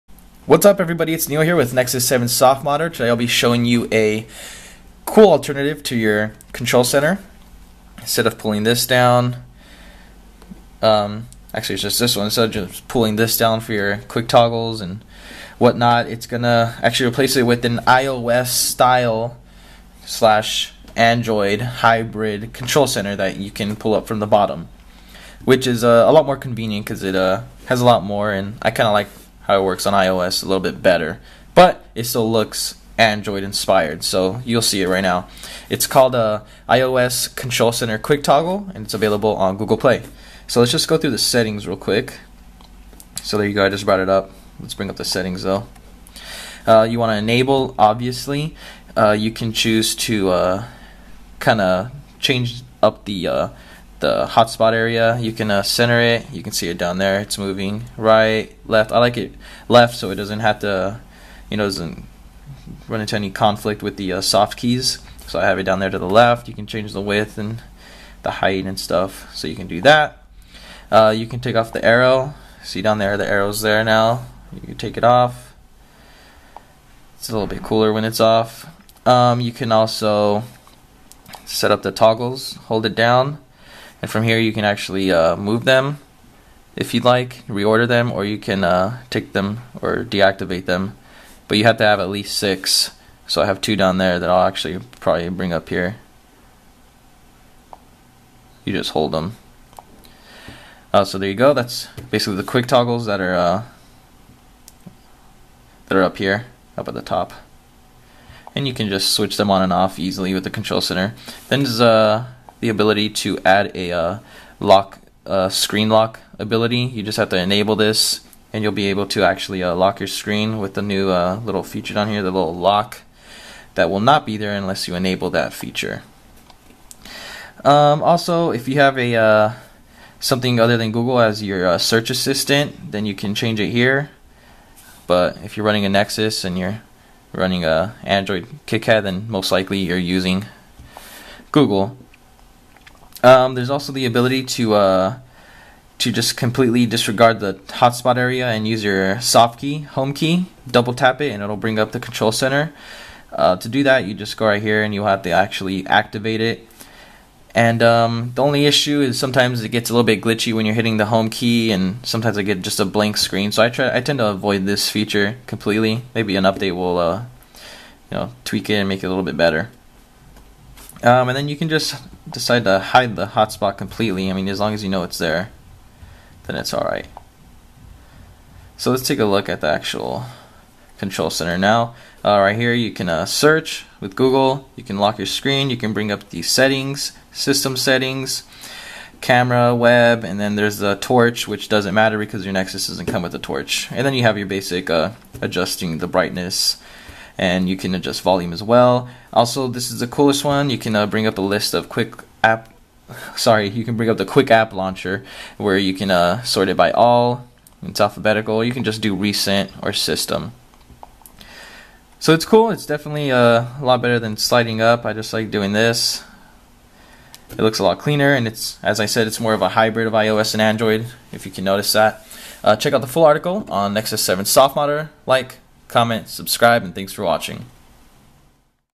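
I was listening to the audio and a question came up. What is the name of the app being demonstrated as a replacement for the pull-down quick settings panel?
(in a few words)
iOS Control Center Quick Toggle.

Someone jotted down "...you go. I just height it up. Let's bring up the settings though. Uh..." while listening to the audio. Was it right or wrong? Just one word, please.
wrong.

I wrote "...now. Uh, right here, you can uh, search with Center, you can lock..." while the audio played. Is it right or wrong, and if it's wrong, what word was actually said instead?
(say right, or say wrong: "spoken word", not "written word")
wrong: "Google", not "Center".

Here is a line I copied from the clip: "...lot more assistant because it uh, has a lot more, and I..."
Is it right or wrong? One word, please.
wrong.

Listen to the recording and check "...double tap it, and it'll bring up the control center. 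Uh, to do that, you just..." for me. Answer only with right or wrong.
right.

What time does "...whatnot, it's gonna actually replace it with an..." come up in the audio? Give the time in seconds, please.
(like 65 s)
15 s.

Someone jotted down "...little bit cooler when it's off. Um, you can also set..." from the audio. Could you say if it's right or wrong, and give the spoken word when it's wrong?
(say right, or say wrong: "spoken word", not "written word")
right.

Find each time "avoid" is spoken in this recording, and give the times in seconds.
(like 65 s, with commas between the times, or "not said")
164 s.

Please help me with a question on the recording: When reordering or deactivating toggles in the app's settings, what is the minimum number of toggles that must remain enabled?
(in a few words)
6.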